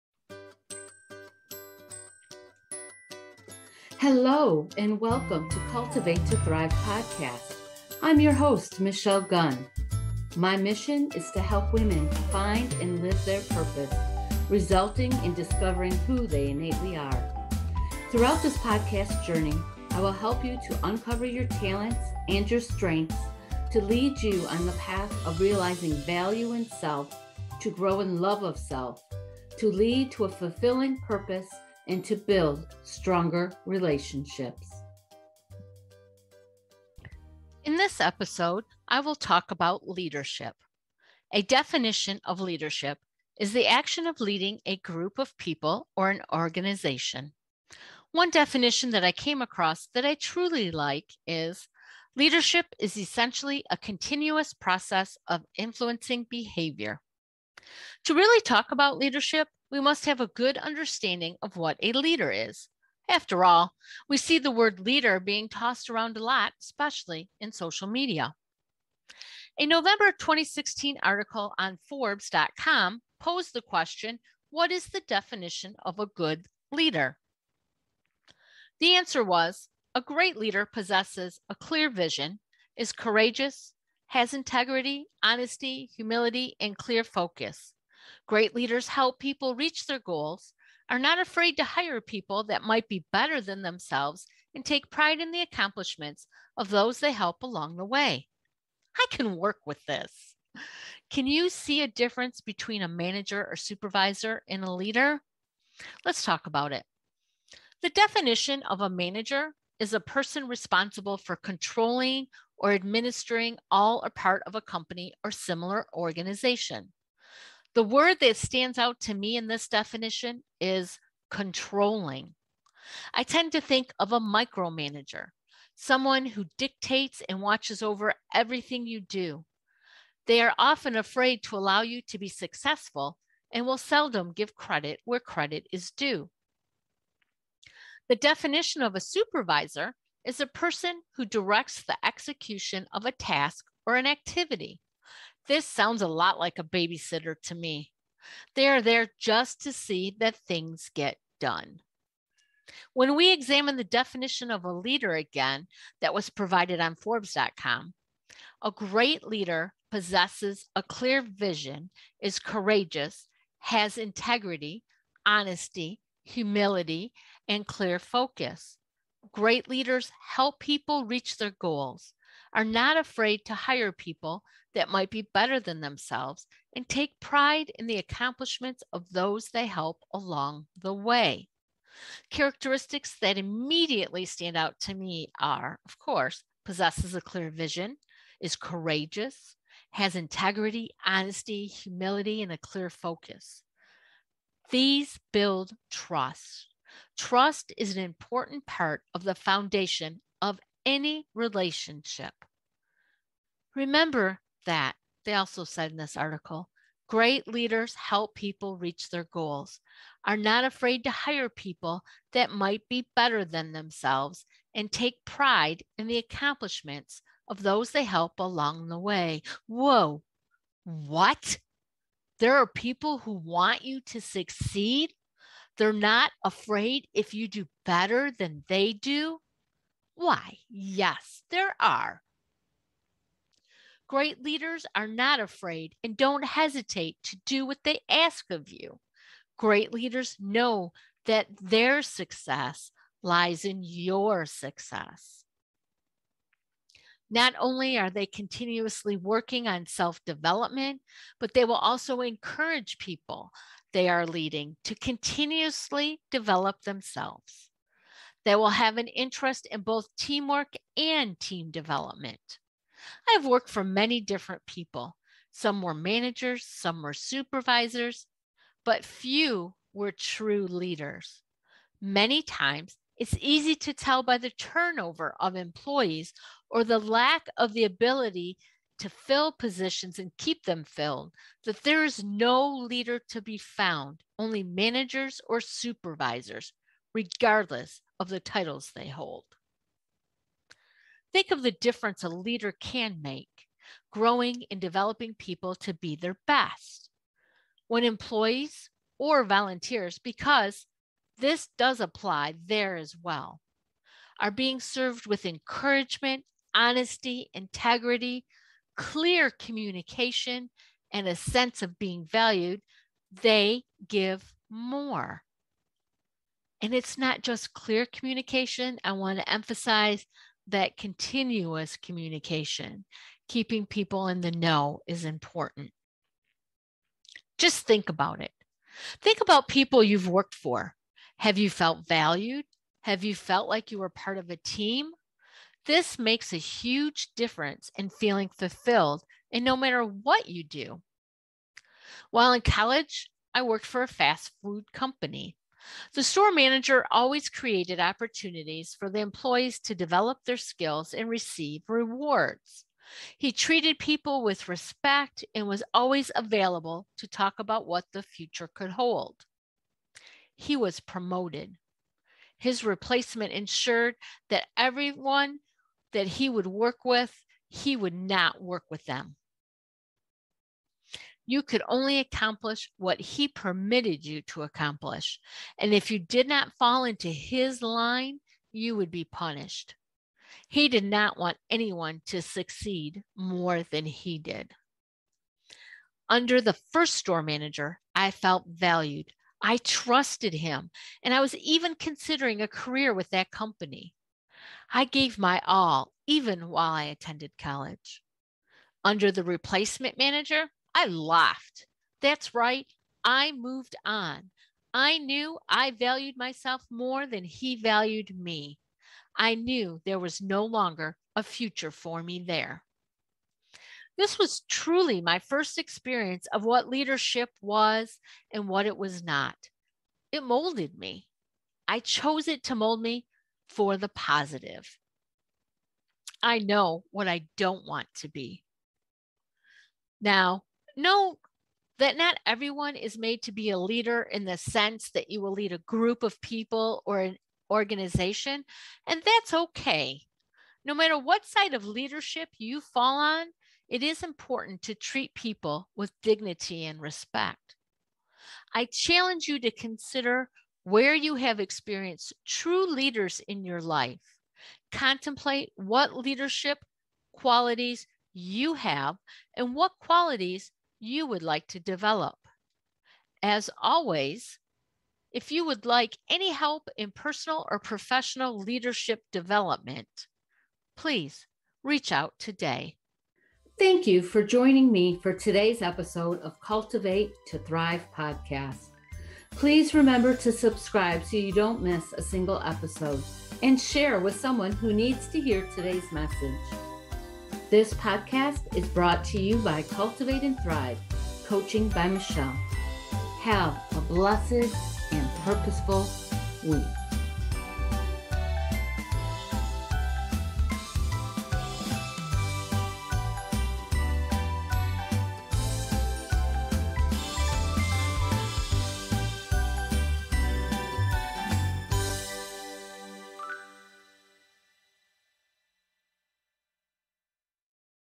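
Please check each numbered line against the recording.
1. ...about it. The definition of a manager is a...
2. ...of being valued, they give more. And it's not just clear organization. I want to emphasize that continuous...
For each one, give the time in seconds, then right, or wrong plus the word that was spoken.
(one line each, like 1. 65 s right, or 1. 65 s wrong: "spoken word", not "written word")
1. 106 s right
2. 311 s wrong: "communication", not "organization".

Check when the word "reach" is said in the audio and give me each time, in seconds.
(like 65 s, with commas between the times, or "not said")
89 s, 171 s, 208 s, 471 s.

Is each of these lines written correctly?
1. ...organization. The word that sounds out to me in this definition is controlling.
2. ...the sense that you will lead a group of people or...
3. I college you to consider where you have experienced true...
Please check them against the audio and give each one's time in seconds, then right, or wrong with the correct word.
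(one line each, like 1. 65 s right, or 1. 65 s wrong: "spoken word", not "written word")
1. 115 s wrong: "stands", not "sounds"
2. 434 s right
3. 448 s wrong: "challenge", not "college".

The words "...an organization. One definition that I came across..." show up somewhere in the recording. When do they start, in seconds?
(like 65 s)
46 s.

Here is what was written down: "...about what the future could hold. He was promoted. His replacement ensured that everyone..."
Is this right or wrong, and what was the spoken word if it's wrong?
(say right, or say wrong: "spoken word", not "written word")
right.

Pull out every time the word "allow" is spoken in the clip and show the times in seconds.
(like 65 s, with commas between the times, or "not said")
131 s.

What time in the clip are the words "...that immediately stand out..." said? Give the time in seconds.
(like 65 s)
183 s.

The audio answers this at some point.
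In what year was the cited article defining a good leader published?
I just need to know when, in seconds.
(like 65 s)
70 s.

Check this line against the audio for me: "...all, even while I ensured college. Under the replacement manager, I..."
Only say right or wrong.
wrong.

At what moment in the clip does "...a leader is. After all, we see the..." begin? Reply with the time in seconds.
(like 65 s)
61 s.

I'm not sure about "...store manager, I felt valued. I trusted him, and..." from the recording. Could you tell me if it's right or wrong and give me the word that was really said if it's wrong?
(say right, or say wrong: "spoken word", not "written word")
right.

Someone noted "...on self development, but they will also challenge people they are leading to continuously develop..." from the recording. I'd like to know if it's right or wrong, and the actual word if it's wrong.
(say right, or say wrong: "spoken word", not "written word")
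wrong: "encourage", not "challenge".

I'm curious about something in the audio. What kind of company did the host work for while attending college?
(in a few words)
fast food company.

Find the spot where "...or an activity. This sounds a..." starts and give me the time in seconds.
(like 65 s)
143 s.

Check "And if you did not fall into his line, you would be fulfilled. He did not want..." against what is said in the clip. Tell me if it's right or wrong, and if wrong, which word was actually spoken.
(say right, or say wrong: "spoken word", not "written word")
wrong: "punished", not "fulfilled".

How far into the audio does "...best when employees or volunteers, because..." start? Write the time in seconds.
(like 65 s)
296 s.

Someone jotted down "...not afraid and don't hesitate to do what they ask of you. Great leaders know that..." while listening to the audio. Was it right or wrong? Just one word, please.
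right.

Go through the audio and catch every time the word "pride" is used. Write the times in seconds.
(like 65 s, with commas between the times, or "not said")
94 s, 177 s, 215 s.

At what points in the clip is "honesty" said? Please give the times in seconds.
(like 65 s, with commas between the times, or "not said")
85 s, 165 s, 191 s, 306 s.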